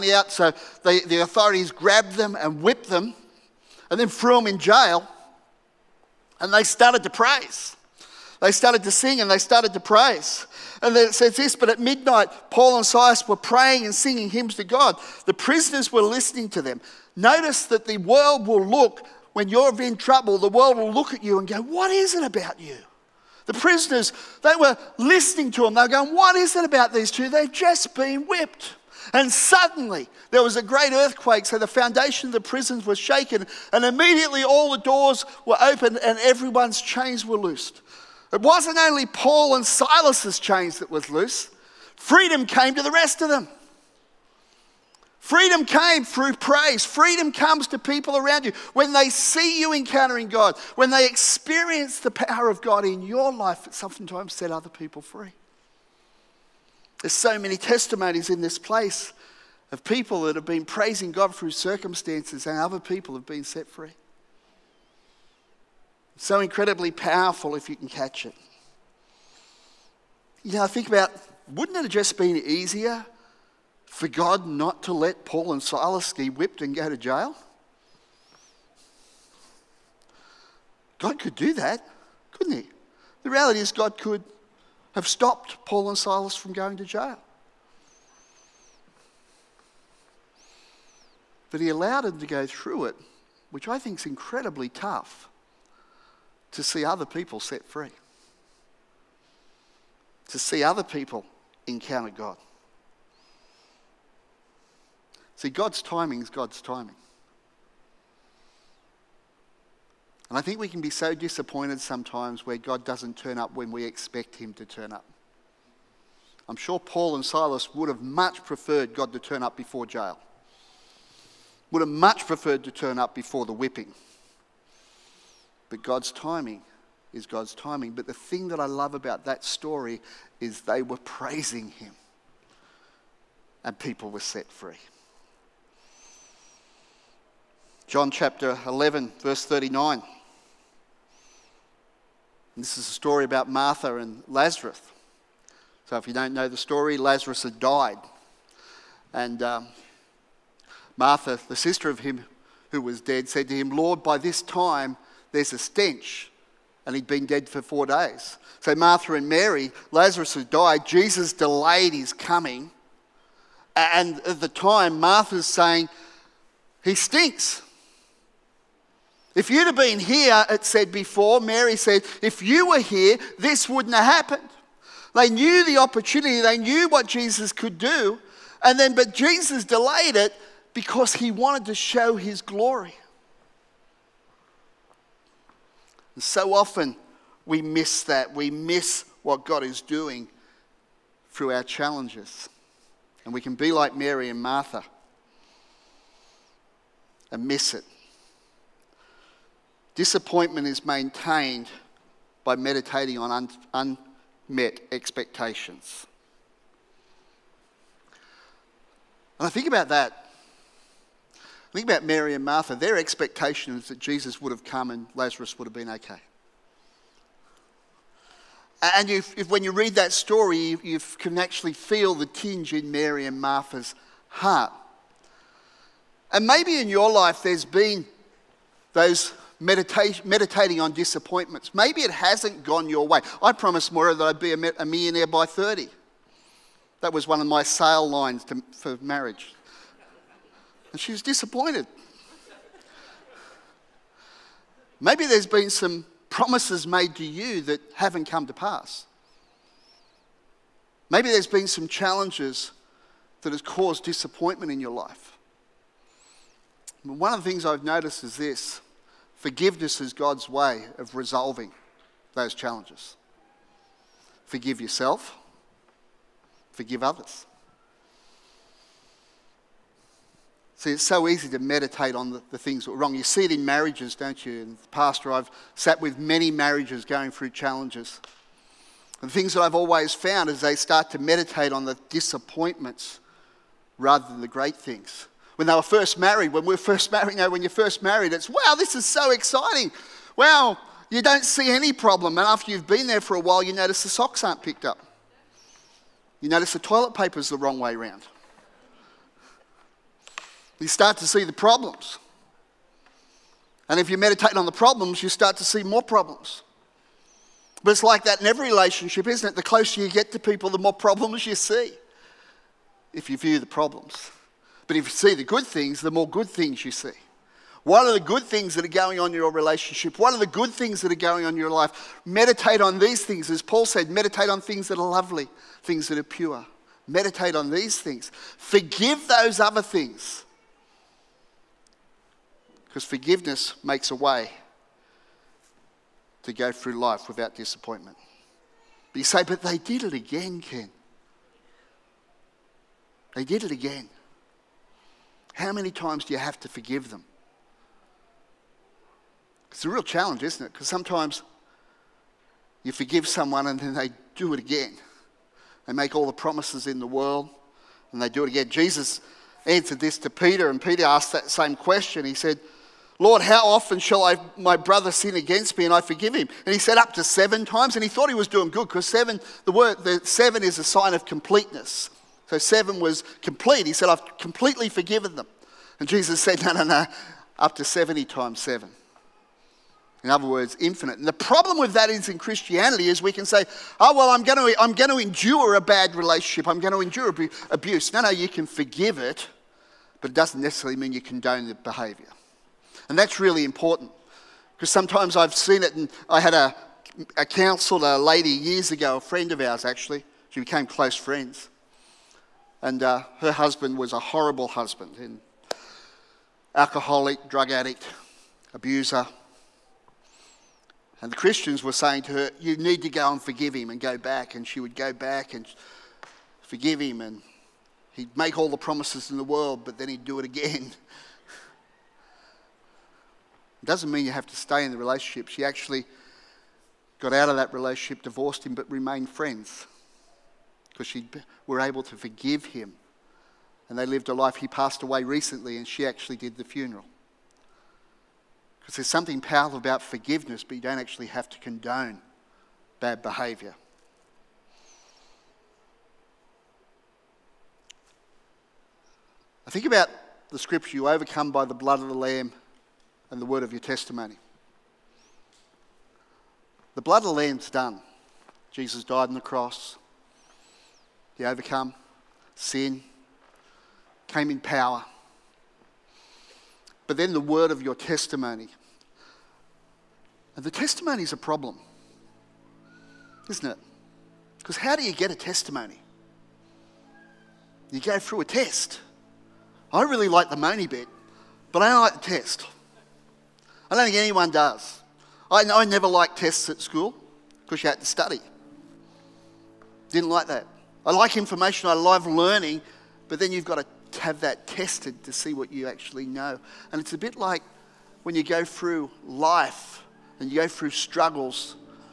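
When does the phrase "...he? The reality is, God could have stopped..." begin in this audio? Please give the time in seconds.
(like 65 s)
82 s.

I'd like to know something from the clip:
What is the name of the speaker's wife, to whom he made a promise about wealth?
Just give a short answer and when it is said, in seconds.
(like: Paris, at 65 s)
Moira, at 233 s.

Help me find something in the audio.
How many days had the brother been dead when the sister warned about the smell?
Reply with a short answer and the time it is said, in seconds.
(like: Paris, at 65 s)
4, at 157 s.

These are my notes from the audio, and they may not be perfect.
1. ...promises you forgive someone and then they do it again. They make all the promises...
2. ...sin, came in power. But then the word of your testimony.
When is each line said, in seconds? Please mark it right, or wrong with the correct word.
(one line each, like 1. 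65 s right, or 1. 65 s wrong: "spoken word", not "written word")
1. 350 s wrong: "sometimes", not "promises"
2. 462 s right.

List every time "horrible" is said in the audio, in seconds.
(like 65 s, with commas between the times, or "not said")
404 s.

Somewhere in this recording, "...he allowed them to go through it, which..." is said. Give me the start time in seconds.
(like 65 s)
91 s.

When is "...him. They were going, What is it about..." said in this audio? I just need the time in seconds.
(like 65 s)
25 s.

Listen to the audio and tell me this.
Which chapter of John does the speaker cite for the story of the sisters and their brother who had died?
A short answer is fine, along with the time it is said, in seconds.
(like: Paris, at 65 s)
Chapter 11, at 137 s.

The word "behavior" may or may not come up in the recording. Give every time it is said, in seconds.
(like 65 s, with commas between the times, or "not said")
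391 s, 443 s.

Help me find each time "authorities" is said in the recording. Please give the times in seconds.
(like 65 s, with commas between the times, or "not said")
1 s.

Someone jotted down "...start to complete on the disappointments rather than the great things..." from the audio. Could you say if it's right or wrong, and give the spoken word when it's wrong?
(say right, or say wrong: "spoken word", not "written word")
wrong: "meditate", not "complete".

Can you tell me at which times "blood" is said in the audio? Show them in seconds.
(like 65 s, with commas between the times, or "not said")
451 s, 457 s.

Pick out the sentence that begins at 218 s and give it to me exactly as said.
And if, if when you read that story, you, you can actually feel the tinge in Mary and Martha's heart.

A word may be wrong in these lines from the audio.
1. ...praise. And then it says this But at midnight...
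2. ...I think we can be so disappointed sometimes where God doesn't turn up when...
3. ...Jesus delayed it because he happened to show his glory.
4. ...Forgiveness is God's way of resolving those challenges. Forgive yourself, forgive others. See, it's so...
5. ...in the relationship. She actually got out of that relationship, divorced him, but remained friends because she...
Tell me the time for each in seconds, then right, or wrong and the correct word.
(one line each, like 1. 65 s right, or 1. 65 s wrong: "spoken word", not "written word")
1. 9 s right
2. 110 s right
3. 179 s wrong: "wanted", not "happened"
4. 259 s right
5. 424 s right.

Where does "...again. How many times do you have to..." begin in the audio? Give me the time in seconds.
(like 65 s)
343 s.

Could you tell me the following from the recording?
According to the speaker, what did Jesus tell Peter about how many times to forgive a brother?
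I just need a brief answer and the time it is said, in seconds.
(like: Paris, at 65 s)
70 times 7, at 377 s.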